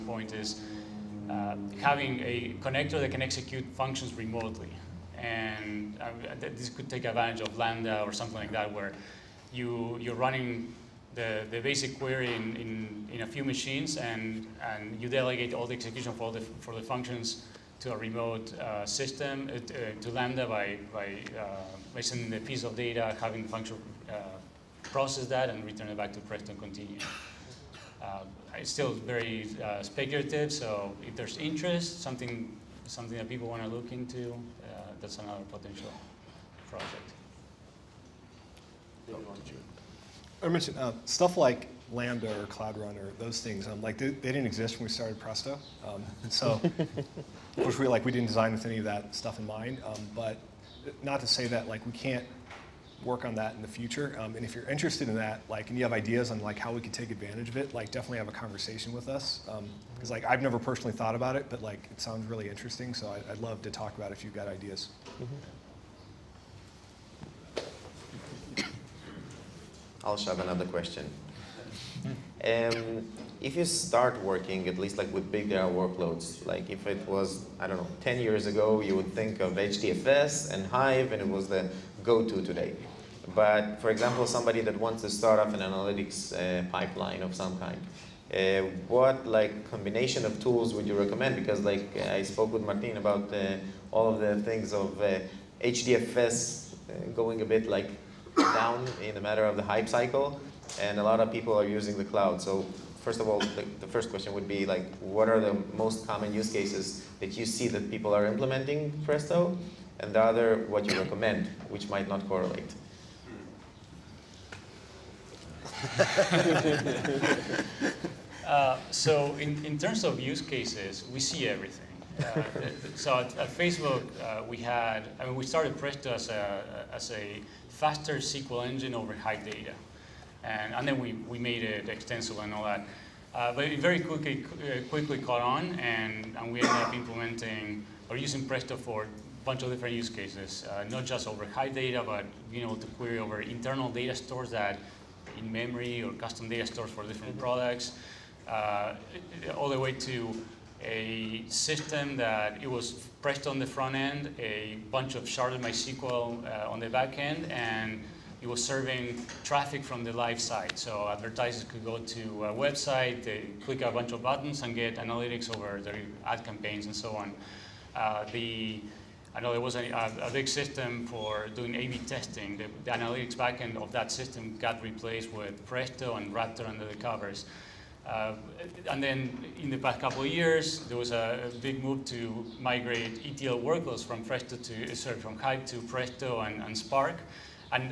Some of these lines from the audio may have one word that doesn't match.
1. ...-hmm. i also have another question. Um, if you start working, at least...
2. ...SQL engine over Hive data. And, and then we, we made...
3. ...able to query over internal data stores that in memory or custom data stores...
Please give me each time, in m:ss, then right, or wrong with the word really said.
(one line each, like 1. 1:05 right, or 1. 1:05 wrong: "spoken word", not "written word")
1. 1:05 right
2. 2:08 right
3. 2:22 right.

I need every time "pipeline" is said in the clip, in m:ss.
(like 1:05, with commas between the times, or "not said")
1:26.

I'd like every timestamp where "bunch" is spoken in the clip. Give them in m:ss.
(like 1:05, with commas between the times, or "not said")
2:19, 2:34, 2:43.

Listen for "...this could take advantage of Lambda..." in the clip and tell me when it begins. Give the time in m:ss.
0:06.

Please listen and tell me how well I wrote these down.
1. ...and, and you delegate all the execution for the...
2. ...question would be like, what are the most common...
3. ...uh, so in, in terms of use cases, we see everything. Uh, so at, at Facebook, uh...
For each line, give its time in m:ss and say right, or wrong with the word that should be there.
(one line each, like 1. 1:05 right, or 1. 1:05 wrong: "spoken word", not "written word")
1. 0:13 right
2. 1:44 right
3. 1:58 right.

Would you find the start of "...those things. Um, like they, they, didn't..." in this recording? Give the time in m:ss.
0:43.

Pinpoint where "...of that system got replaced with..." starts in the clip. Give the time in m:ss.
2:53.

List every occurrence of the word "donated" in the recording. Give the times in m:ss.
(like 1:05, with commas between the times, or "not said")
not said.